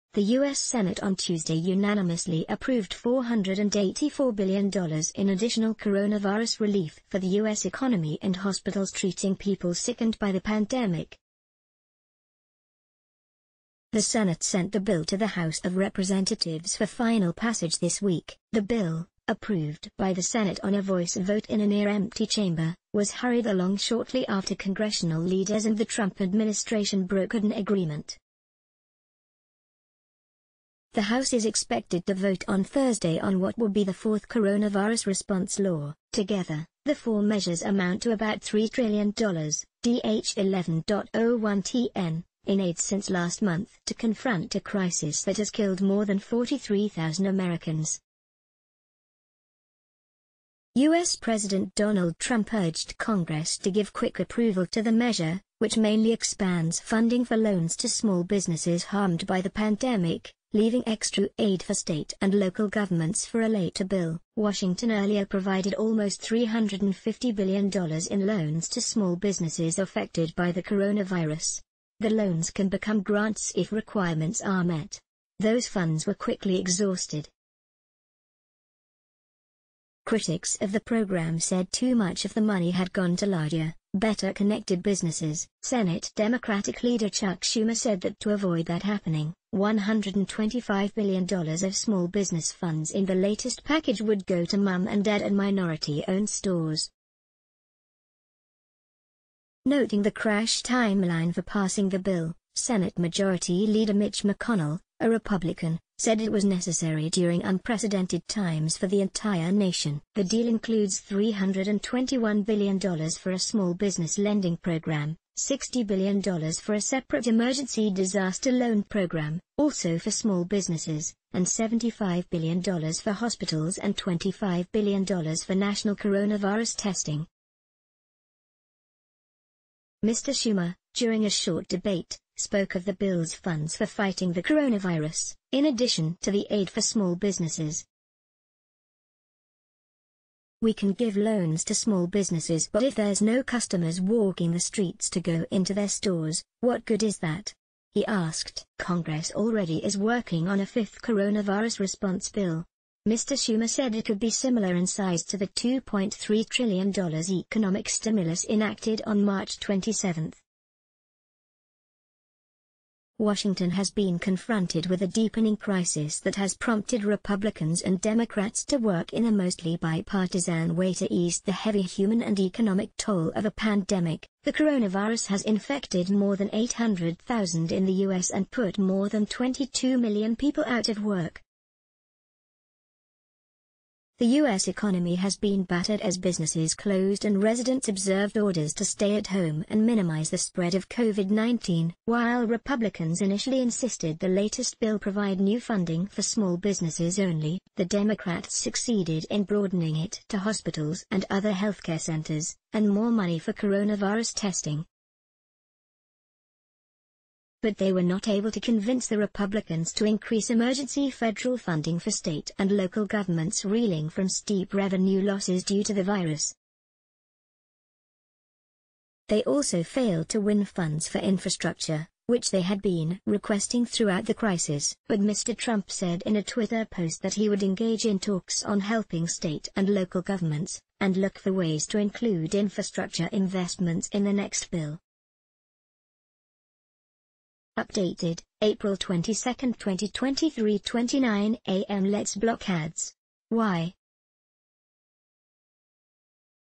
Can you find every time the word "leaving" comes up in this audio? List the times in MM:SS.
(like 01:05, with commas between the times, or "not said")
01:00.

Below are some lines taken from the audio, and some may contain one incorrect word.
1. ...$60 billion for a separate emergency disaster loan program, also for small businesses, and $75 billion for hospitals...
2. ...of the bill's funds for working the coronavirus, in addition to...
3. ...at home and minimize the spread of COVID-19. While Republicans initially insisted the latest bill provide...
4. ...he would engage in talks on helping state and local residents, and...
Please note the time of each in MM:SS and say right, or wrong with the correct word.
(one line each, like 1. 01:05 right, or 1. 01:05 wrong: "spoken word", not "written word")
1. 01:55 right
2. 02:12 wrong: "fighting", not "working"
3. 03:09 right
4. 03:47 wrong: "governments", not "residents".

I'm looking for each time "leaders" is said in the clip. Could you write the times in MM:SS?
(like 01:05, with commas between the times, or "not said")
00:25, 01:26, 01:43.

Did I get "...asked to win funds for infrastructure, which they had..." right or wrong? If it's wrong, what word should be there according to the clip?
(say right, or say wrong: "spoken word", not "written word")
wrong: "failed", not "asked".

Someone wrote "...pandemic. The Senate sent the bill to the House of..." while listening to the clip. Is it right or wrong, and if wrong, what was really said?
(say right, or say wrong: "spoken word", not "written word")
right.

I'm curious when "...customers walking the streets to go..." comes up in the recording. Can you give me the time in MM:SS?
02:23.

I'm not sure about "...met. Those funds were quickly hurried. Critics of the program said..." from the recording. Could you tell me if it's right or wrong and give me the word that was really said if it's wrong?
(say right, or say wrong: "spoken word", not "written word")
wrong: "exhausted", not "hurried".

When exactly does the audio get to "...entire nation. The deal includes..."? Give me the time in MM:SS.
01:49.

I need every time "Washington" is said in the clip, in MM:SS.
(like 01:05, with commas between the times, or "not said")
01:04, 02:43.